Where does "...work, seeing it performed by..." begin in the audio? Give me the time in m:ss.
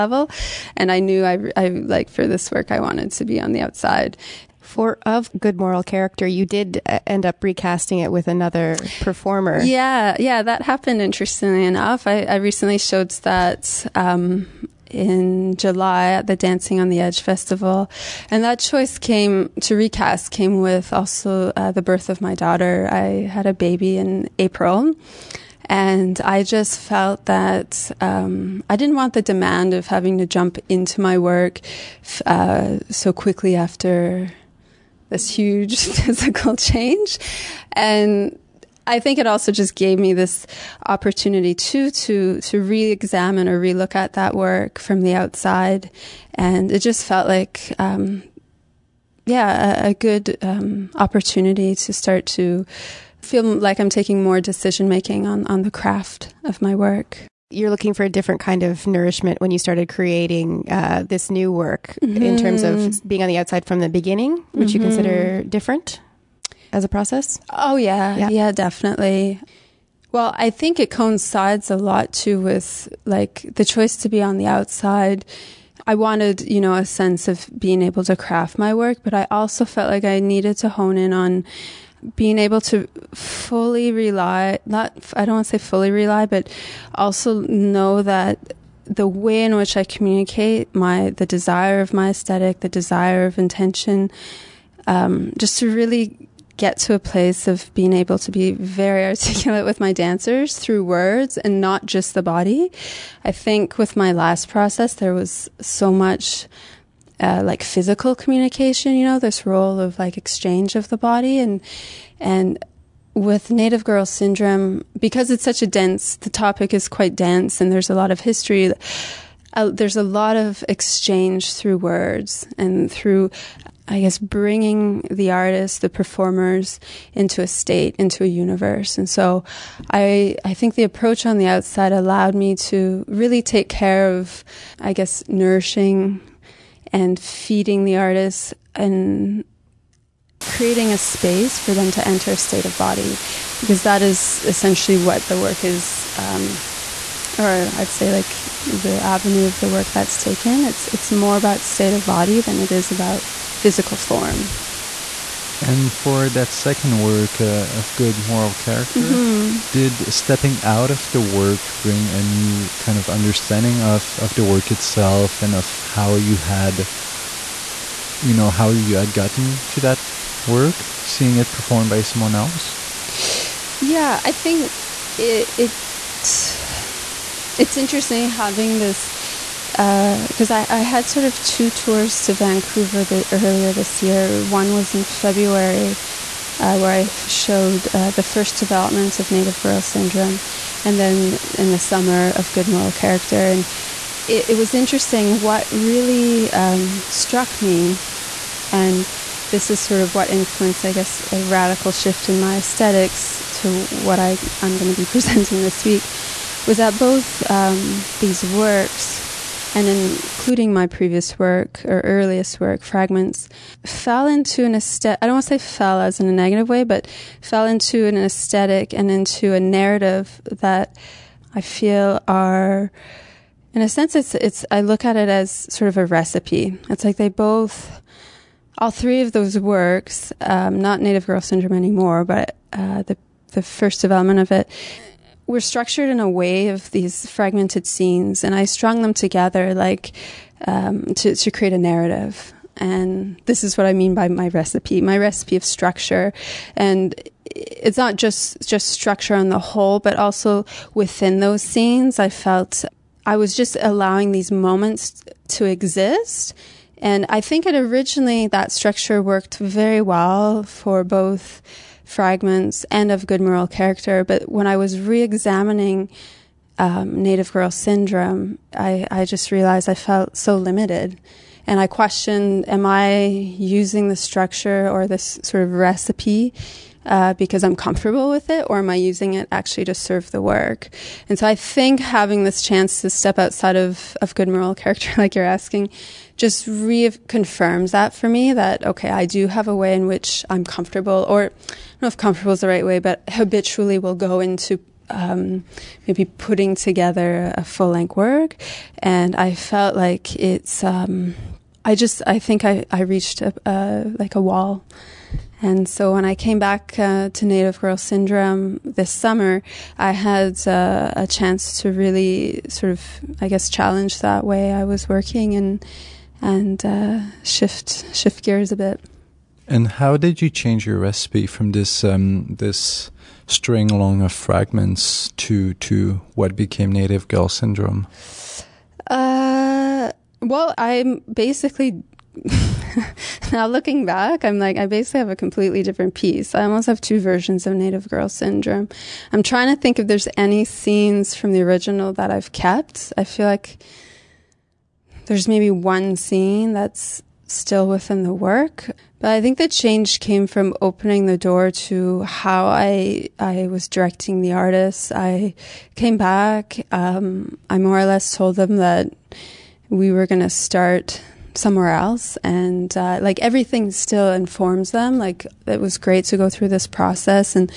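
2:50.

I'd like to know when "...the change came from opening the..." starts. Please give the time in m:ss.
5:49.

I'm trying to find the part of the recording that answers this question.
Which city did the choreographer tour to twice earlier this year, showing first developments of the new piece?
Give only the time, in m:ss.
3:02.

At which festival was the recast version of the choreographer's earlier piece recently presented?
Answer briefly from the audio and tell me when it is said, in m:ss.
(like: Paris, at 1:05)
Dancing on the Edge Festival, at 0:16.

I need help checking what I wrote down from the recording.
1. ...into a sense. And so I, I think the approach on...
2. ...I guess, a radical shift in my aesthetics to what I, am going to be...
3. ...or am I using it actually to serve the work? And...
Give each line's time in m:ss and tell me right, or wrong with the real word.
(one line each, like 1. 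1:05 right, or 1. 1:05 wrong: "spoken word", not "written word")
1. 2:07 wrong: "universe", not "sense"
2. 3:20 right
3. 4:38 right.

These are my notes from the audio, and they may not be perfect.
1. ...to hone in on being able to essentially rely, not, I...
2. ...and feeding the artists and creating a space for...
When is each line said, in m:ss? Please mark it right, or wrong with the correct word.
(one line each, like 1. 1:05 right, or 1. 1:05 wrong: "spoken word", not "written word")
1. 1:20 wrong: "fully", not "essentially"
2. 2:16 right.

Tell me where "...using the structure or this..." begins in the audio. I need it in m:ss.
4:33.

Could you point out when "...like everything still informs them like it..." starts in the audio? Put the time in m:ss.
6:03.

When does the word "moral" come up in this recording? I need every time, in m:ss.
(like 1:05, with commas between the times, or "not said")
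0:05, 2:38, 3:12, 4:23, 4:44.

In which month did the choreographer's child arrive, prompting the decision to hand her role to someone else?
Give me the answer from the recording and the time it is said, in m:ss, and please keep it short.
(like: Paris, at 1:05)
April, at 0:24.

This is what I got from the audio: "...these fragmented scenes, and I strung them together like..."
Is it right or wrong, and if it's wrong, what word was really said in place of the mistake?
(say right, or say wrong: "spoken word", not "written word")
right.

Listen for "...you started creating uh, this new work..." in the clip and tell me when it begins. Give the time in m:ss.
0:59.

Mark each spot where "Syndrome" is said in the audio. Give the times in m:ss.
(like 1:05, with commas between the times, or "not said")
1:54, 3:09, 3:51, 4:27, 5:07, 5:27, 5:38.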